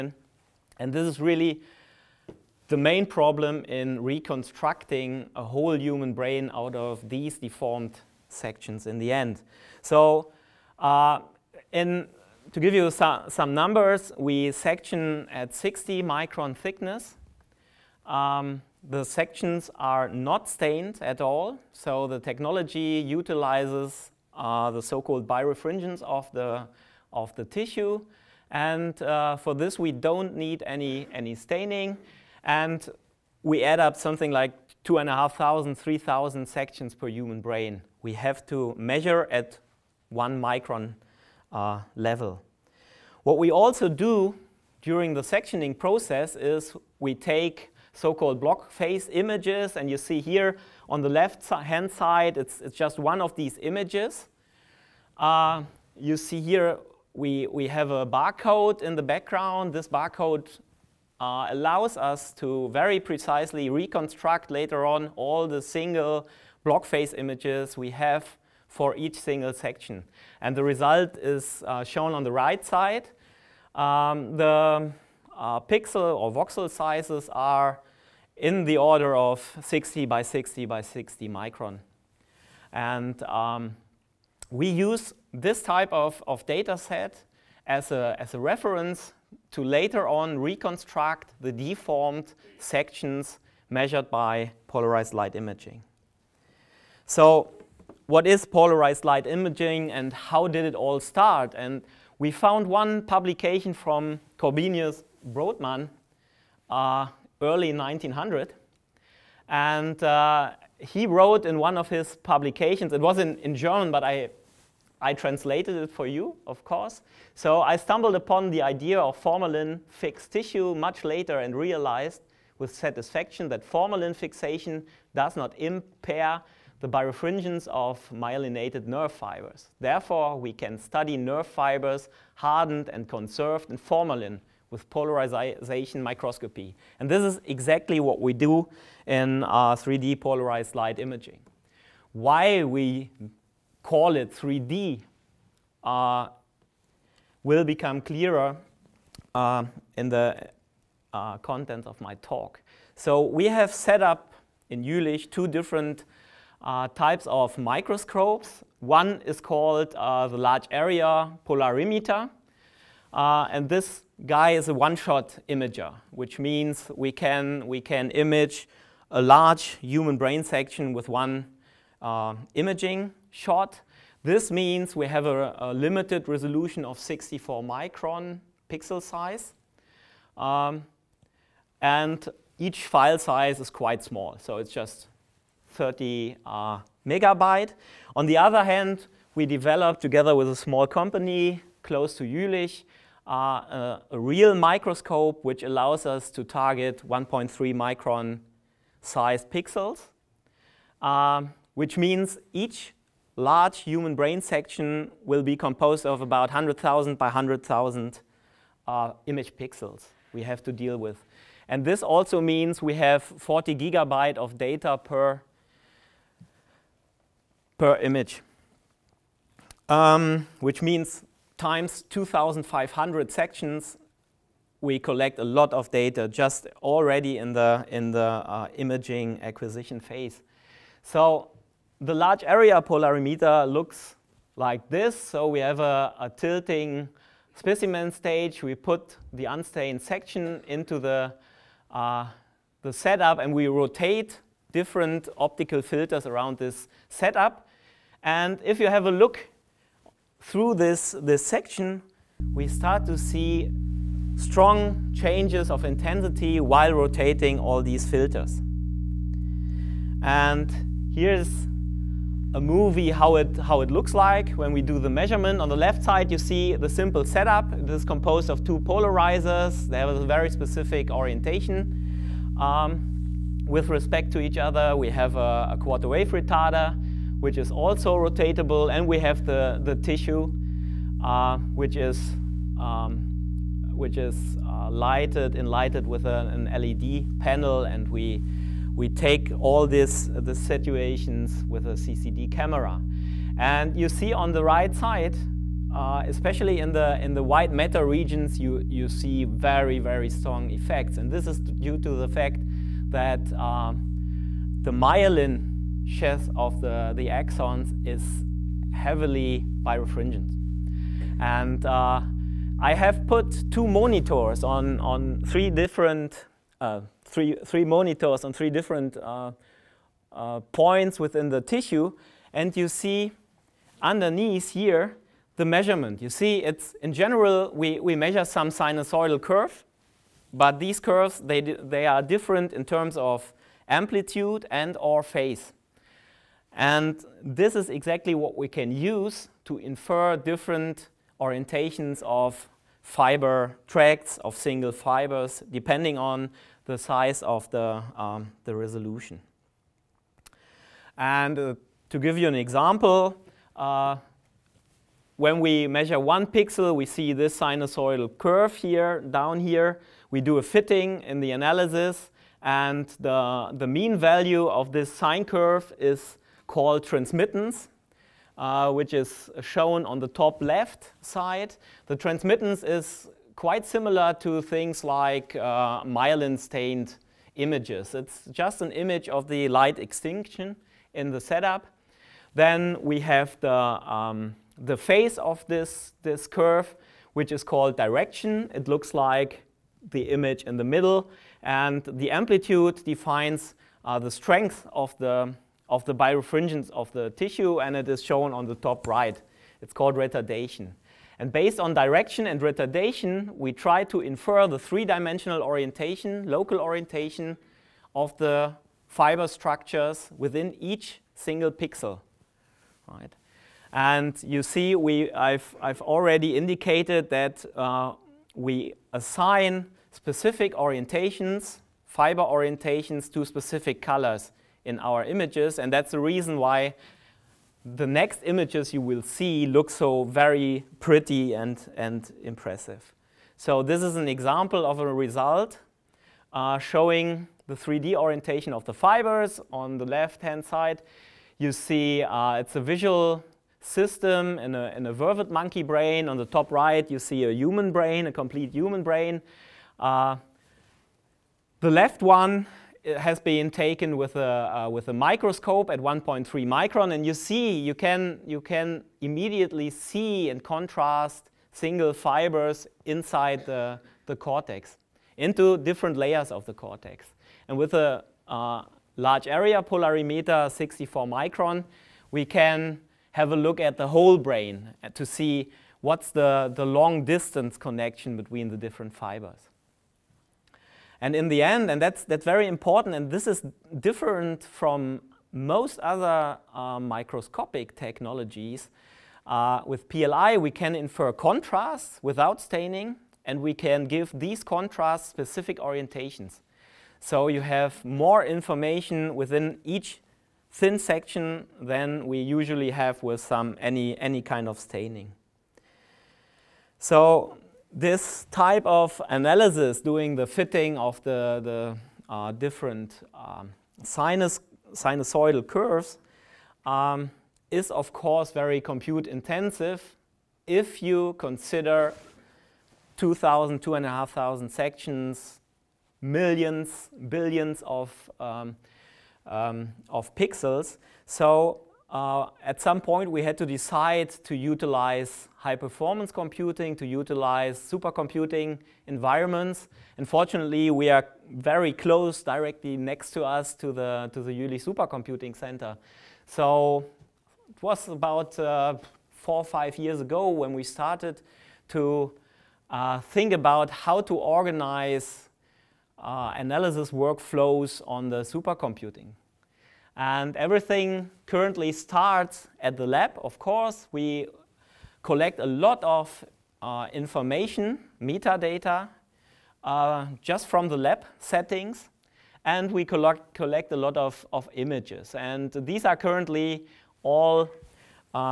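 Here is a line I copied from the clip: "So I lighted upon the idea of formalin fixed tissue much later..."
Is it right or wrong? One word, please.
wrong.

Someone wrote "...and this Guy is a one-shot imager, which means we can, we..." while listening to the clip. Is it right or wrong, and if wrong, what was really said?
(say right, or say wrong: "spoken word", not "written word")
right.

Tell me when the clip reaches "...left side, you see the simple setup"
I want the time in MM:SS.
04:25.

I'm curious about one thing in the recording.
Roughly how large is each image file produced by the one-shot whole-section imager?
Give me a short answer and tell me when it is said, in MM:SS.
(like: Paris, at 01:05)
30 megabytes, at 03:05.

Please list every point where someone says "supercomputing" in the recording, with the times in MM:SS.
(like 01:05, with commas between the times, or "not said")
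08:57, 09:04, 09:18.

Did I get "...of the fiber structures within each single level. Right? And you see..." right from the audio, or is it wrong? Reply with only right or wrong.
wrong.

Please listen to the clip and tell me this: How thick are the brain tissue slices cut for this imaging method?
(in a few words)
60 microns.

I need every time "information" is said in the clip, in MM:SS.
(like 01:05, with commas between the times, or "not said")
08:18, 09:27.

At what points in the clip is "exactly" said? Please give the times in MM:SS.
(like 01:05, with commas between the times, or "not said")
02:17, 05:37.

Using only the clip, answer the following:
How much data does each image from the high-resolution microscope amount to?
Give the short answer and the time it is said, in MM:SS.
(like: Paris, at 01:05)
40 gigabytes, at 03:33.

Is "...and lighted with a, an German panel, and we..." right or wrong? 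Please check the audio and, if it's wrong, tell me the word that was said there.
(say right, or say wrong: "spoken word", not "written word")
wrong: "LED", not "German".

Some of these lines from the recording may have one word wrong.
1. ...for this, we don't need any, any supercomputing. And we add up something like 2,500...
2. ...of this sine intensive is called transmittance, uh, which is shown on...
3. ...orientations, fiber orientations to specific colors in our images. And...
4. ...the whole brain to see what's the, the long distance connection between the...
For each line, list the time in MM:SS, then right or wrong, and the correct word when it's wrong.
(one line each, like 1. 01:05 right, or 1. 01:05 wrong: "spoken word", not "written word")
1. 00:29 wrong: "staining", not "supercomputing"
2. 06:04 wrong: "curve", not "intensive"
3. 07:00 right
4. 07:53 right.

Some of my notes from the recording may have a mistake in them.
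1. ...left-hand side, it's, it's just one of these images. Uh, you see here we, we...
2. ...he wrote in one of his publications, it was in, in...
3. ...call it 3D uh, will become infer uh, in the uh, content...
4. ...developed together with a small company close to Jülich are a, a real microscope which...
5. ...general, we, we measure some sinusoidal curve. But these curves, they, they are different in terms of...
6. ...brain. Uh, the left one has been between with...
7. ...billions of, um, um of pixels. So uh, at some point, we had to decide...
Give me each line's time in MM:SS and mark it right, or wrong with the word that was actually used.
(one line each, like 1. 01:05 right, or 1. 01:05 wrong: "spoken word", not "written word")
1. 00:51 right
2. 01:50 right
3. 02:23 wrong: "clearer", not "infer"
4. 03:09 right
5. 05:27 right
6. 07:29 wrong: "taken", not "between"
7. 08:47 right.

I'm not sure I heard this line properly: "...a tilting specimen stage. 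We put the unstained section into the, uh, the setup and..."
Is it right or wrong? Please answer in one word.
right.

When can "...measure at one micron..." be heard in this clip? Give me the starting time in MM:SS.
00:38.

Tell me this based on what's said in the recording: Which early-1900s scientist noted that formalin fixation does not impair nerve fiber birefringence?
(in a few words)
Korbinian Brodmann.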